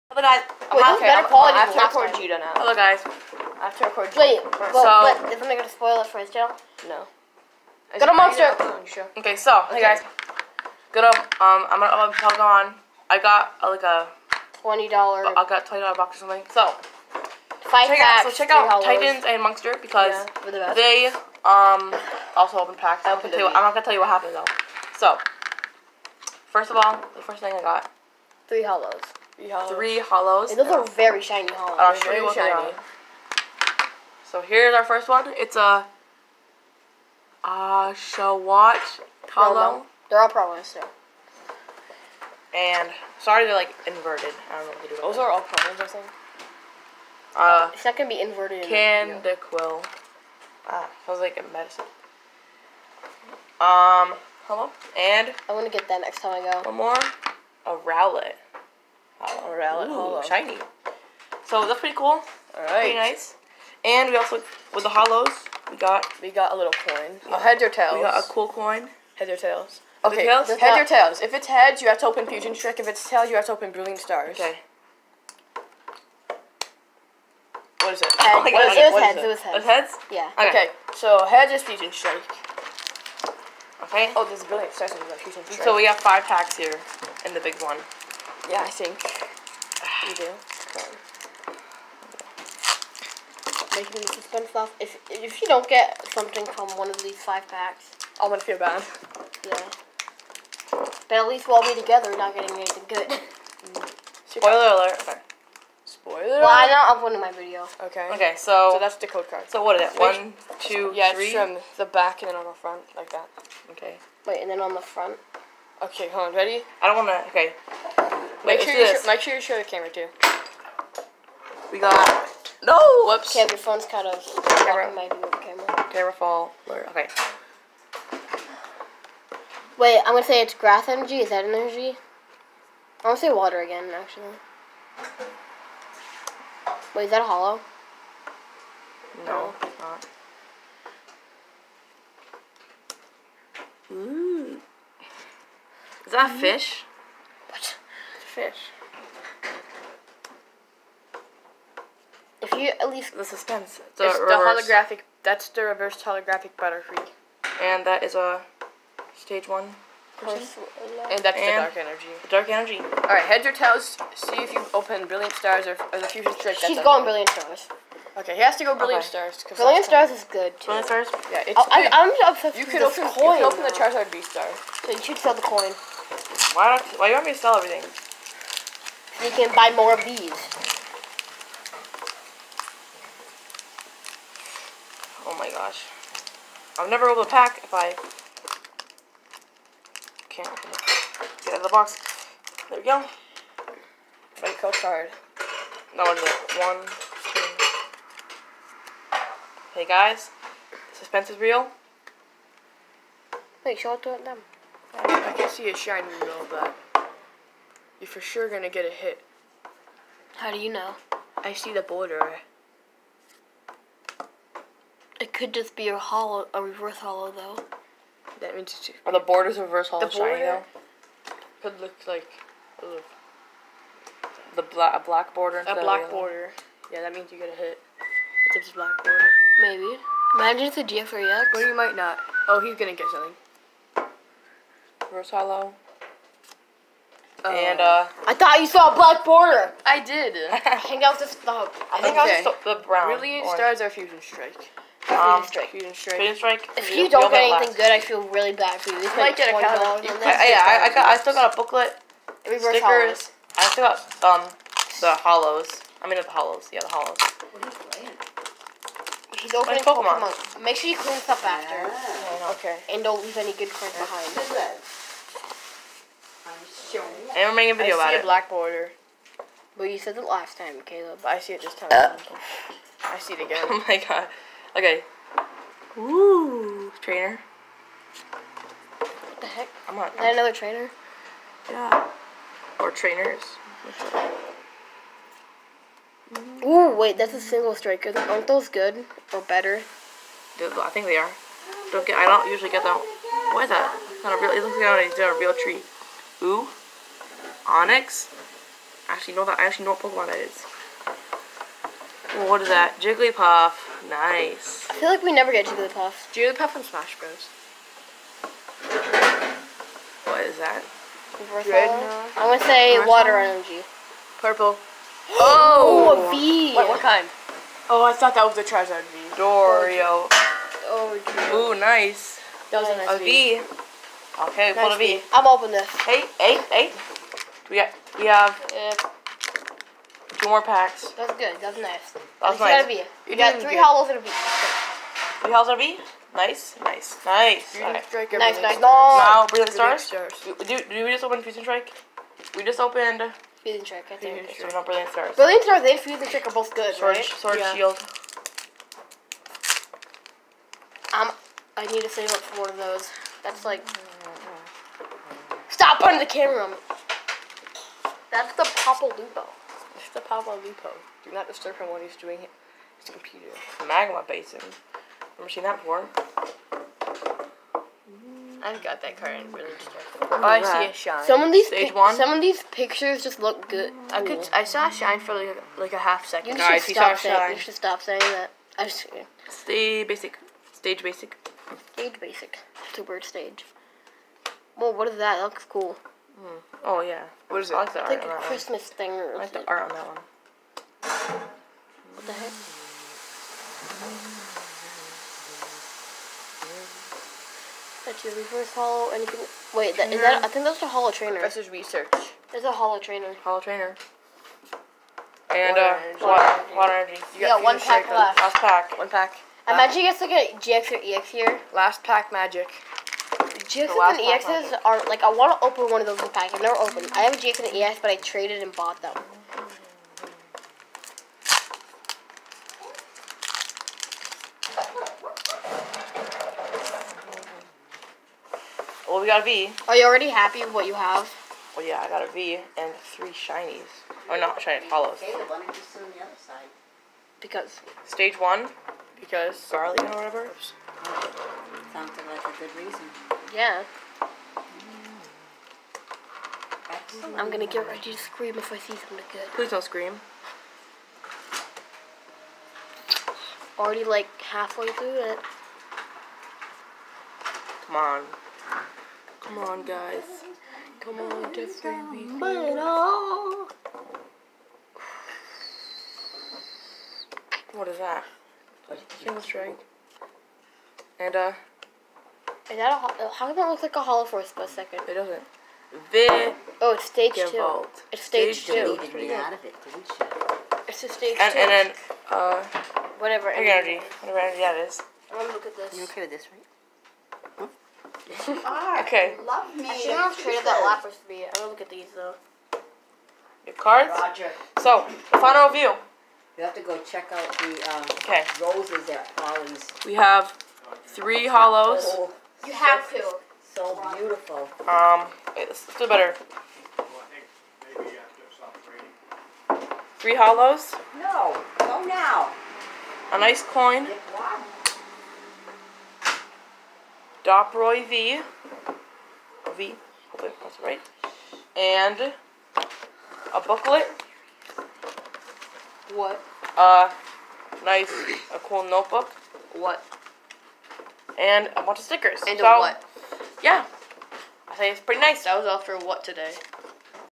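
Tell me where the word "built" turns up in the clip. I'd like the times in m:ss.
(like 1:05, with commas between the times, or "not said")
not said.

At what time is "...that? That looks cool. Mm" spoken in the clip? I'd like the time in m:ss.
6:25.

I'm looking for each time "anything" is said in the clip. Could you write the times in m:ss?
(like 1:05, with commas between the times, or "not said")
1:42, 4:07, 6:39.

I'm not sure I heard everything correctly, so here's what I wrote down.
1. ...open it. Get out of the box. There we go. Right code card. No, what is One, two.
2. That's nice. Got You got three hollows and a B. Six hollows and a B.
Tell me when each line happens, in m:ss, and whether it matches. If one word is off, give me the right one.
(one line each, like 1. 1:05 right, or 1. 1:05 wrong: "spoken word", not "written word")
1. 3:10 right
2. 5:32 wrong: "Three", not "Six".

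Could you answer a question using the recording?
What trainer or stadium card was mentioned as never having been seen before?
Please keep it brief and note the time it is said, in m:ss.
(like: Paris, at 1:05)
Magma Basin, at 6:03.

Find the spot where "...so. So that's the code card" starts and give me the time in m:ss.
1:48.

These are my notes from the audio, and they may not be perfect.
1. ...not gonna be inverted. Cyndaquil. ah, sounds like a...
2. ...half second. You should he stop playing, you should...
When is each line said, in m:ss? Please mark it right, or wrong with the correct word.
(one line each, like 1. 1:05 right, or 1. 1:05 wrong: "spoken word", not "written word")
1. 0:47 right
2. 6:15 wrong: "saying", not "playing".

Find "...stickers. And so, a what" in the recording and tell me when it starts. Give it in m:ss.
8:52.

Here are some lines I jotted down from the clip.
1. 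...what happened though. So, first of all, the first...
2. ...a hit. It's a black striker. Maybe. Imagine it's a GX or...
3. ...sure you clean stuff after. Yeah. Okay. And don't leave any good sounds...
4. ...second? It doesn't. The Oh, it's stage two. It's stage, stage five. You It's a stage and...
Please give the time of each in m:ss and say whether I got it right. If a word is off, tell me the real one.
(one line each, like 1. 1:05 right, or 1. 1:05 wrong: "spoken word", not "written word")
1. 0:24 right
2. 3:47 wrong: "border", not "striker"
3. 4:20 wrong: "cards", not "sounds"
4. 7:54 wrong: "two", not "five".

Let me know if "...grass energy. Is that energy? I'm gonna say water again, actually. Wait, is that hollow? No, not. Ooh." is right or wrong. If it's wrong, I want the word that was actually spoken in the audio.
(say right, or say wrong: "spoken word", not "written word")
right.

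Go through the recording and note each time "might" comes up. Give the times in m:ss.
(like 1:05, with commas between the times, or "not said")
3:51, 4:09.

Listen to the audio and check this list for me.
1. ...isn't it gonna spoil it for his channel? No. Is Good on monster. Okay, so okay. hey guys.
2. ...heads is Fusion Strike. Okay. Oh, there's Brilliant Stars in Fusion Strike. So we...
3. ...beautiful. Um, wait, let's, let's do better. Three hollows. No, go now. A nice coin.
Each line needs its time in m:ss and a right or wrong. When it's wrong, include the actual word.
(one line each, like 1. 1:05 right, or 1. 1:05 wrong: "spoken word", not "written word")
1. 0:05 right
2. 1:21 right
3. 8:24 right.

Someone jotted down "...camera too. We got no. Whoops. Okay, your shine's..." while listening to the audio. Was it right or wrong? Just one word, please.
wrong.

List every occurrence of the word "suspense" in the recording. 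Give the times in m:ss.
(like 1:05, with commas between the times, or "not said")
1:34, 2:33, 3:20.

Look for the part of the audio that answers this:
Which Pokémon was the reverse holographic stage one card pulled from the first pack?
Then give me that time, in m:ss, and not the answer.
2:36.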